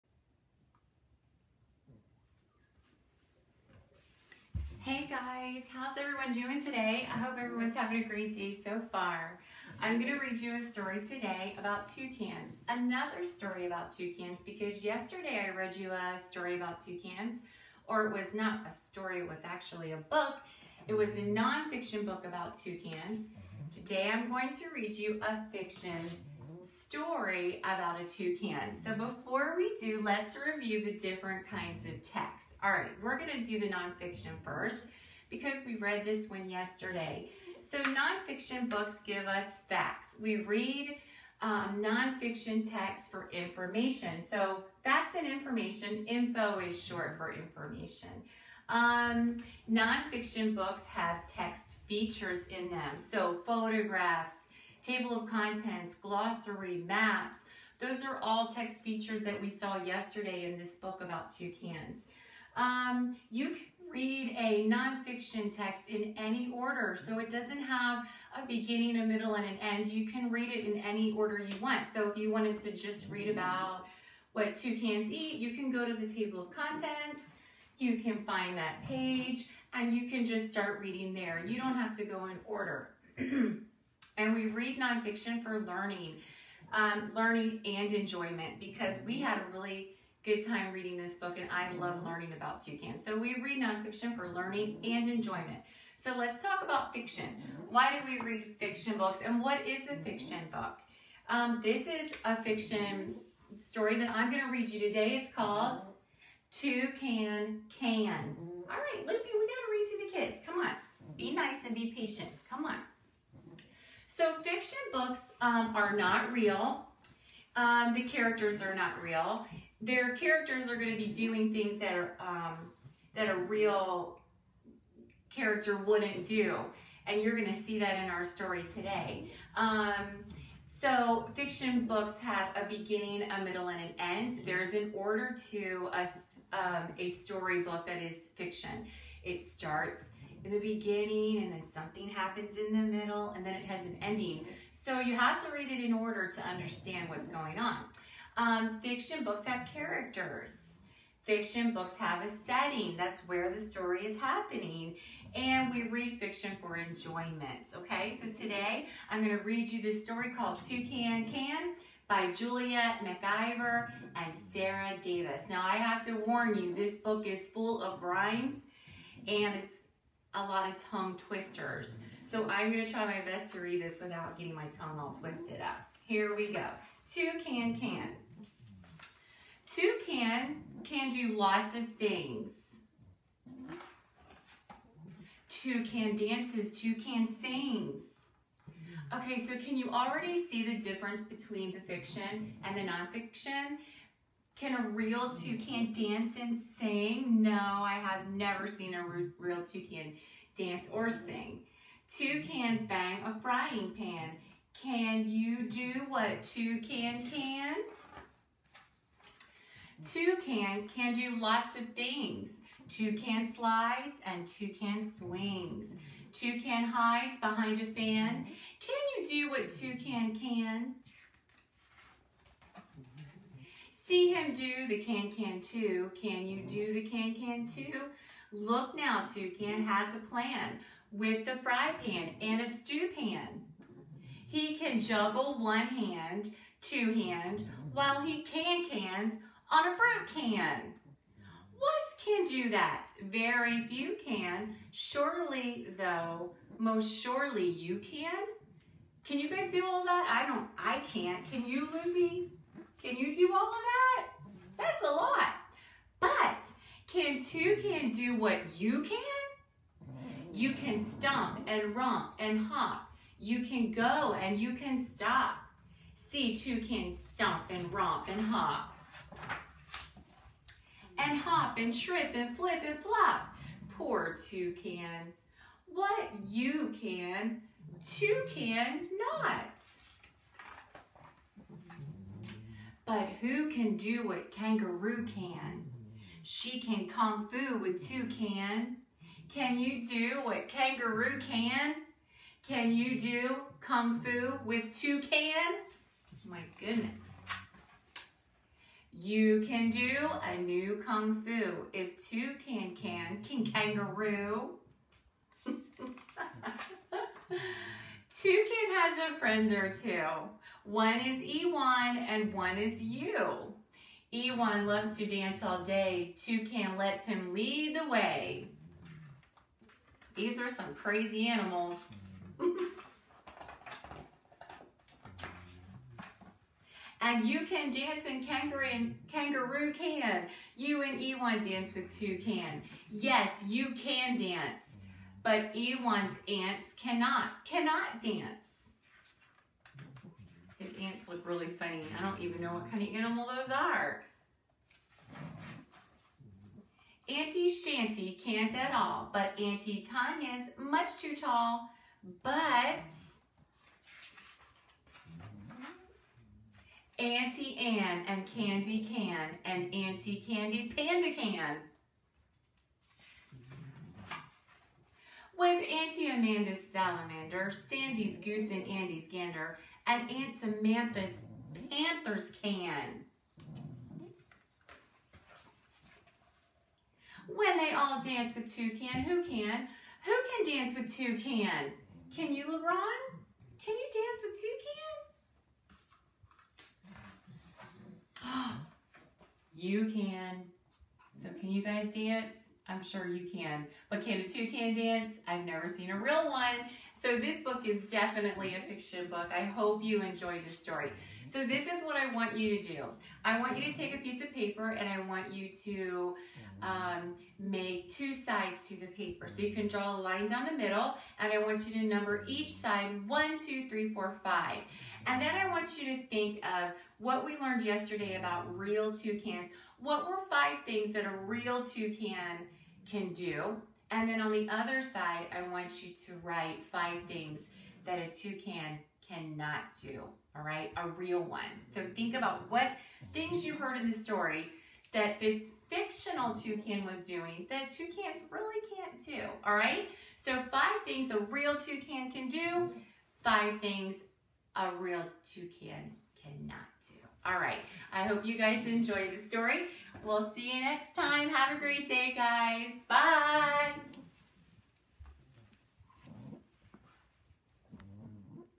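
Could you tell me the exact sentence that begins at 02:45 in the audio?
Now I have to warn you, this book is full of rhymes and it's a lot of tongue twisters.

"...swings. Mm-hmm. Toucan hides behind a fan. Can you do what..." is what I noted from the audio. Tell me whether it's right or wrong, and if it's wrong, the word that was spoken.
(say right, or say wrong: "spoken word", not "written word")
right.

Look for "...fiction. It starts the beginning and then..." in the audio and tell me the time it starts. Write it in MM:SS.
02:18.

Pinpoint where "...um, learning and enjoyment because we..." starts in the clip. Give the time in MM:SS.
01:26.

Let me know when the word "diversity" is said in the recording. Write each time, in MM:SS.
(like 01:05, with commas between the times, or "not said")
not said.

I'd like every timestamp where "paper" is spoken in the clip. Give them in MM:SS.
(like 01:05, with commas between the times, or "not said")
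06:44, 06:49.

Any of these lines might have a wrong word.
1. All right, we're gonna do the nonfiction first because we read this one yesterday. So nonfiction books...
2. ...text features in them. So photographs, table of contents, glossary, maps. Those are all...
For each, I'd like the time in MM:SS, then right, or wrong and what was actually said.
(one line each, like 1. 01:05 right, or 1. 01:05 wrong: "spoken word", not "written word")
1. 00:32 right
2. 00:51 right.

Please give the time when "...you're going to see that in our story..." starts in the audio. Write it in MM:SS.
02:07.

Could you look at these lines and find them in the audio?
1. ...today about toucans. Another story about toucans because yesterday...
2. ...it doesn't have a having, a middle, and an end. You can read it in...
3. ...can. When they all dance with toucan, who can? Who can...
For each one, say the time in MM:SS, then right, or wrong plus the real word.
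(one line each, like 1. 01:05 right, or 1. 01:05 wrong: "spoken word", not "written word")
1. 00:11 right
2. 01:07 wrong: "beginning", not "having"
3. 06:12 right.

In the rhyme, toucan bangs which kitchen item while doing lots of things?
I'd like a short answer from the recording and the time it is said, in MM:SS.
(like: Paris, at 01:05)
frying pan, at 03:23.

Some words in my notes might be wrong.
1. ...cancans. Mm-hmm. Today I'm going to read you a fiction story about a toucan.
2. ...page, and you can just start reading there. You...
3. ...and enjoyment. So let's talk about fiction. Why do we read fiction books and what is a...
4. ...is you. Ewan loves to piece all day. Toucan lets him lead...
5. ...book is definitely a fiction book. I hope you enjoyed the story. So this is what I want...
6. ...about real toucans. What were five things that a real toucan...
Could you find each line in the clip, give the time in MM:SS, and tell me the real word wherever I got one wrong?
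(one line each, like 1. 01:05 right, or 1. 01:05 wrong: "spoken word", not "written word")
1. 00:22 wrong: "toucans", not "cancans"
2. 01:18 right
3. 01:34 right
4. 05:12 wrong: "dance", not "piece"
5. 06:37 right
6. 06:58 right.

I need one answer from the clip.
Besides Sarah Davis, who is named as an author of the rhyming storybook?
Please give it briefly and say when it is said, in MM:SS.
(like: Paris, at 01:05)
Julia MacIver, at 02:42.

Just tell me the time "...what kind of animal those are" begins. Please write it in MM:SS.
05:42.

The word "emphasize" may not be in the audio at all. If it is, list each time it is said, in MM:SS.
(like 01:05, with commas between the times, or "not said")
not said.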